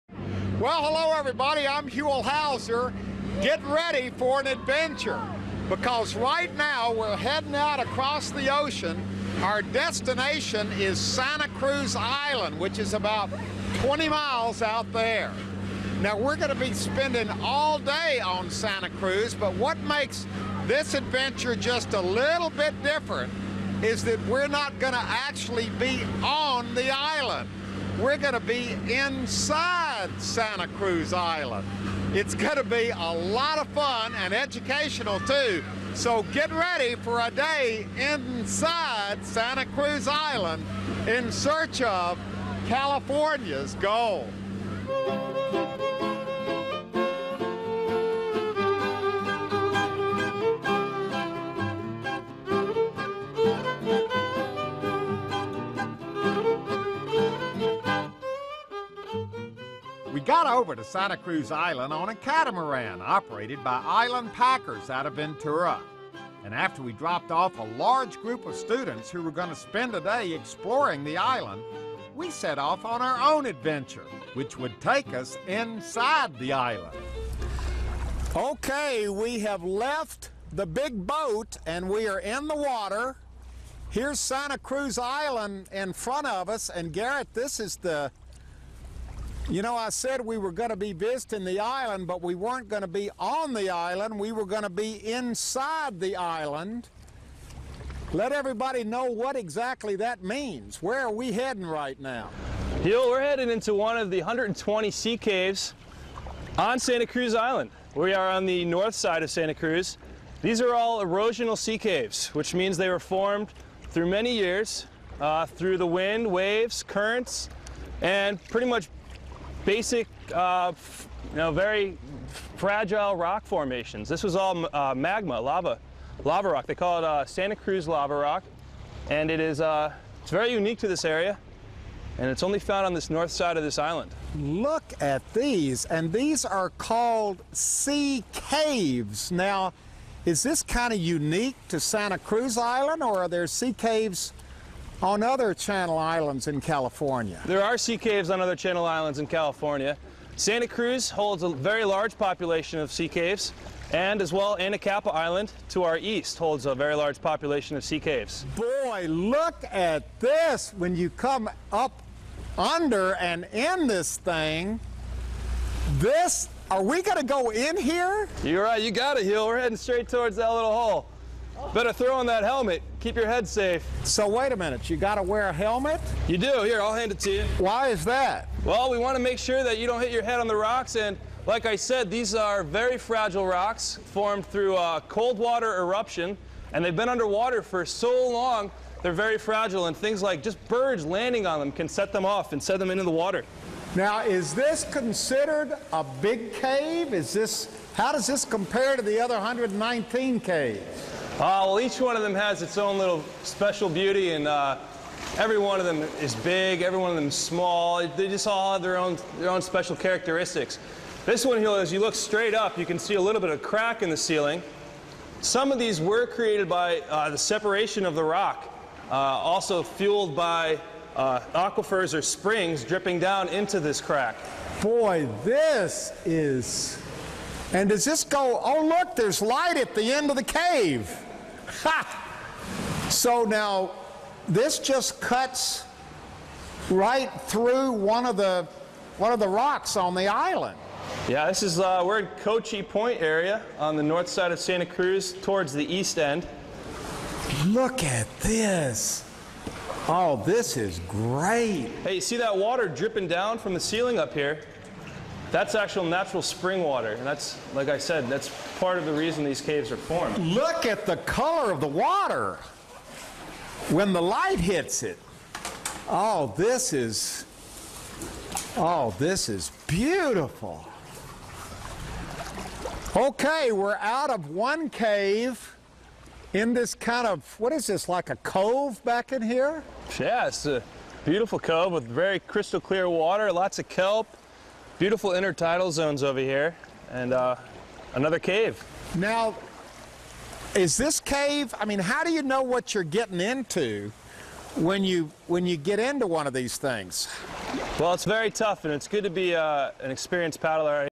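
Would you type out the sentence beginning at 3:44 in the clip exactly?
Boy, this is and does this go, oh, look, there's light at the end of the cave?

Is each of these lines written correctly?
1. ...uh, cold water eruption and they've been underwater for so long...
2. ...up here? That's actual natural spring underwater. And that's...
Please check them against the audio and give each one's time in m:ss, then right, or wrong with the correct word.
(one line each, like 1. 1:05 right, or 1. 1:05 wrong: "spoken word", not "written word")
1. 3:04 right
2. 4:14 wrong: "water", not "underwater".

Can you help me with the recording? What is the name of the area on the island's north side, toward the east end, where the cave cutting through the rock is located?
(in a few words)
Cochi Point.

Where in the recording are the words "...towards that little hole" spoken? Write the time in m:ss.
2:50.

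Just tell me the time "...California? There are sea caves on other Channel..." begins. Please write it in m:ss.
2:26.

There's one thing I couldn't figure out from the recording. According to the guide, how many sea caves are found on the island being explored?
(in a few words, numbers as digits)
120.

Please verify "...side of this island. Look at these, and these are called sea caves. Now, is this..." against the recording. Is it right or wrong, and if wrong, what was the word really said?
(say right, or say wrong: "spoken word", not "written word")
right.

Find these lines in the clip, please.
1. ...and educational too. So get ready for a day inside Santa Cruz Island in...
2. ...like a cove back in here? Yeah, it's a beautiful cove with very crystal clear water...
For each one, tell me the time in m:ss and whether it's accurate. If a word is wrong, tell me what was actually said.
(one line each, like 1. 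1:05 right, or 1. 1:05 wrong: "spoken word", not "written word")
1. 0:34 right
2. 4:38 right.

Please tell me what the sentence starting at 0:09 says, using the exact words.
Our destination is Santa Cruz Island, which is about 20 miles out there.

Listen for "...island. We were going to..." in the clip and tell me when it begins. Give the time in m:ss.
1:33.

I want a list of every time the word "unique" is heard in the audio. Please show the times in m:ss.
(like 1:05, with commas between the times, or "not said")
2:10, 2:20.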